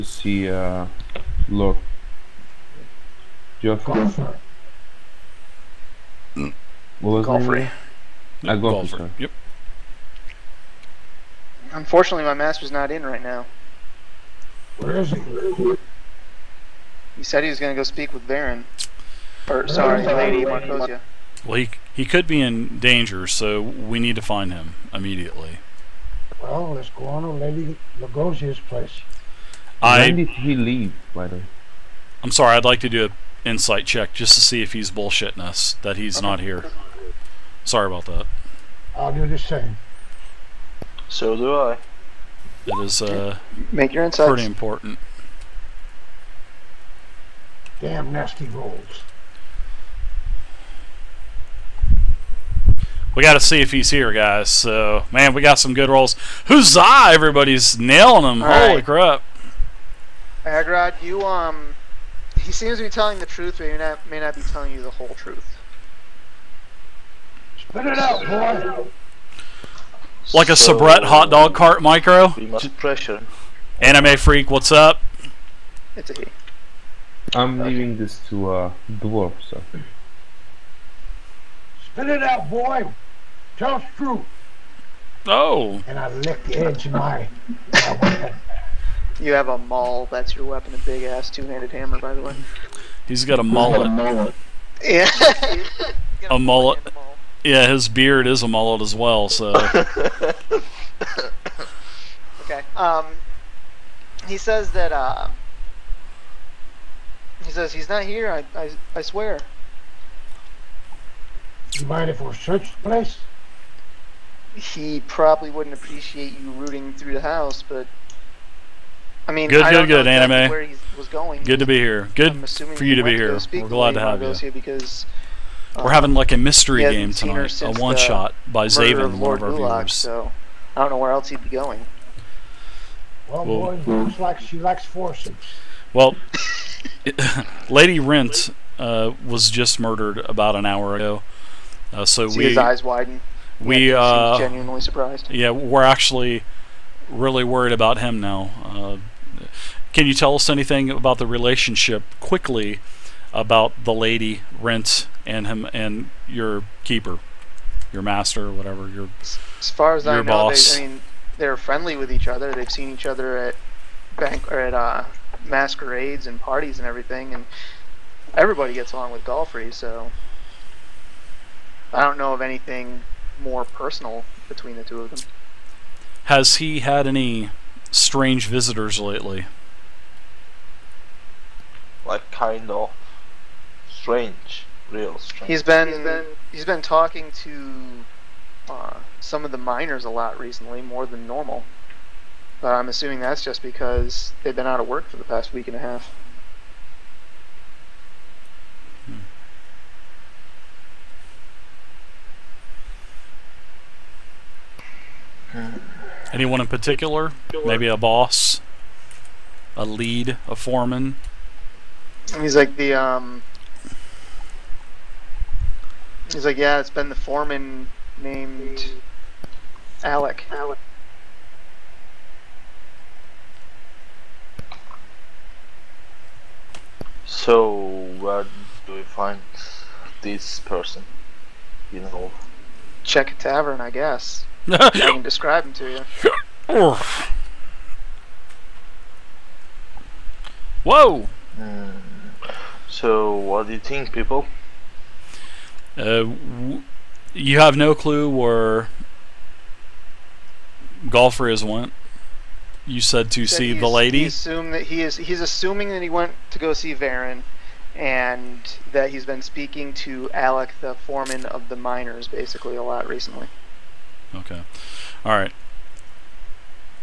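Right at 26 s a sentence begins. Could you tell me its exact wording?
Well, let's go on to Lady Lugosia's place.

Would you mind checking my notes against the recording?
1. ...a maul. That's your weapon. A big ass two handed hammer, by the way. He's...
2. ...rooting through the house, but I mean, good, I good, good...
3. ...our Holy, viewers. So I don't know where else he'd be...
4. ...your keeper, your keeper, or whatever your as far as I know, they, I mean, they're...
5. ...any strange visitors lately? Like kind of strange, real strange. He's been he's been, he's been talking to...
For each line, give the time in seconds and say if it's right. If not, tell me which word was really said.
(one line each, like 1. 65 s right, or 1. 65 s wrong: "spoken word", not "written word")
1. 89 s right
2. 116 s right
3. 129 s wrong: "Gulak", not "Holy"
4. 156 s wrong: "master", not "keeper"
5. 177 s right.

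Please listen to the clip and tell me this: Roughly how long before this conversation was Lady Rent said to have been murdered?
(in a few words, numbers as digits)
about an hour.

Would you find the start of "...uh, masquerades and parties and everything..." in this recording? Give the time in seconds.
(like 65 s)
164 s.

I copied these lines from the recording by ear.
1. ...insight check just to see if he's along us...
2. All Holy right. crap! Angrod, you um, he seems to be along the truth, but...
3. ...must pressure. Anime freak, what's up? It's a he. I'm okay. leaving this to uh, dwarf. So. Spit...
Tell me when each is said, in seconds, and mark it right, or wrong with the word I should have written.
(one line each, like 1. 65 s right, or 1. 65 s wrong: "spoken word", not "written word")
1. 33 s wrong: "bullshitting", not "along"
2. 58 s wrong: "telling", not "along"
3. 72 s right.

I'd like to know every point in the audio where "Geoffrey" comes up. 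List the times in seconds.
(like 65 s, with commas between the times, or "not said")
3 s.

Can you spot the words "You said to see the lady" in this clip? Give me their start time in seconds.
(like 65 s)
252 s.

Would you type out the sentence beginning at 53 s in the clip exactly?
we got to see if he's here, guys.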